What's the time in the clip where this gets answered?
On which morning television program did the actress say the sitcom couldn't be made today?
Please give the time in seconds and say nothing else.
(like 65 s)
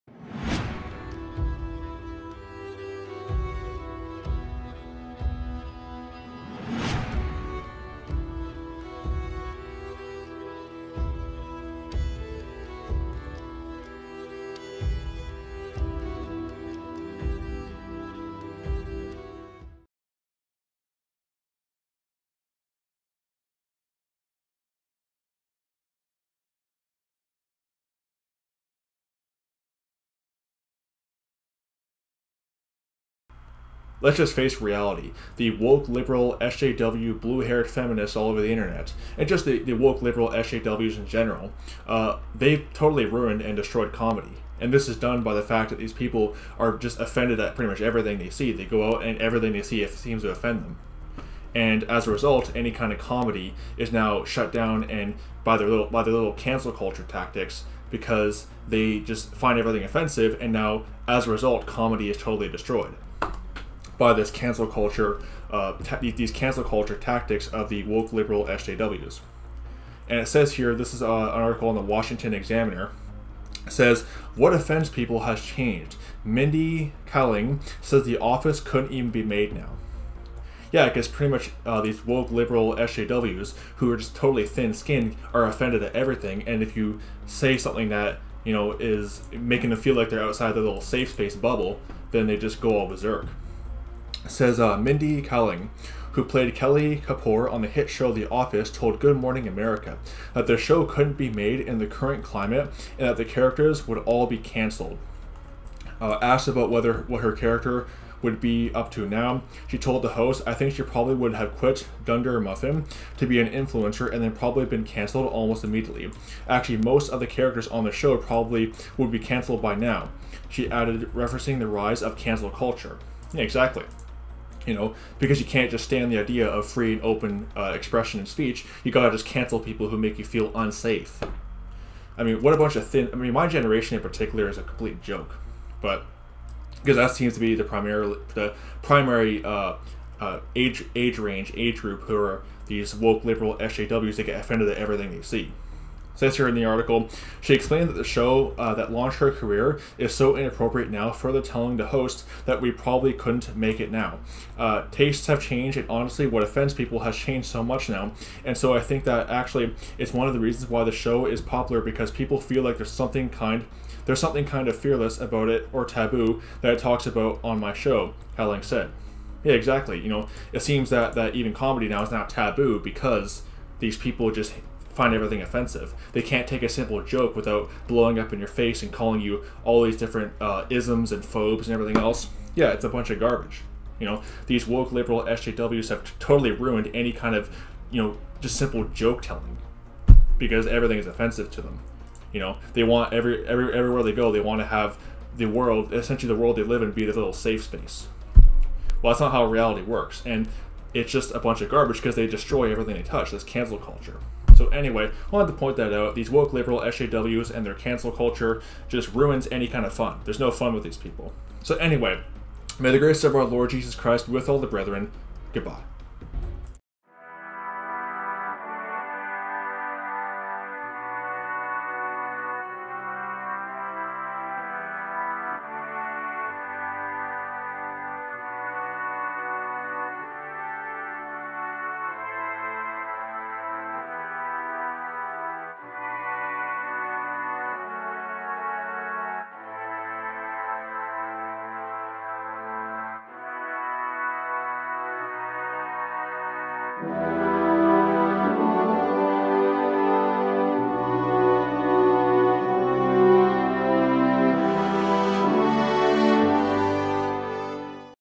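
98 s.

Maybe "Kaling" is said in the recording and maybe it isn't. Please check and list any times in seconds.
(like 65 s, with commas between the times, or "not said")
77 s, 95 s, 168 s.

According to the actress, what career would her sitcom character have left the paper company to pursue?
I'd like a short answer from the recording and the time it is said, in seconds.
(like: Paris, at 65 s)
influencer, at 113 s.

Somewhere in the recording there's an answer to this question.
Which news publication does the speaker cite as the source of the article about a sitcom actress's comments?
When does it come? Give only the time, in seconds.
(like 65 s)
71 s.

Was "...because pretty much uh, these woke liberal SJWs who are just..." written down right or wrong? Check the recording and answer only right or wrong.
right.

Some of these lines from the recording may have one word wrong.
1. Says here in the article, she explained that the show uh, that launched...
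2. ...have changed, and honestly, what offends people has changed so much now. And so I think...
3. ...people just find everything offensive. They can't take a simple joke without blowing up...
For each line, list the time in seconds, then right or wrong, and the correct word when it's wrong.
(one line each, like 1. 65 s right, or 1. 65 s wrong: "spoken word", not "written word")
1. 146 s right
2. 155 s right
3. 173 s right.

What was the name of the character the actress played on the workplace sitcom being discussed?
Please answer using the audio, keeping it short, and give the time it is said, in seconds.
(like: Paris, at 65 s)
Kelly Kapoor, at 96 s.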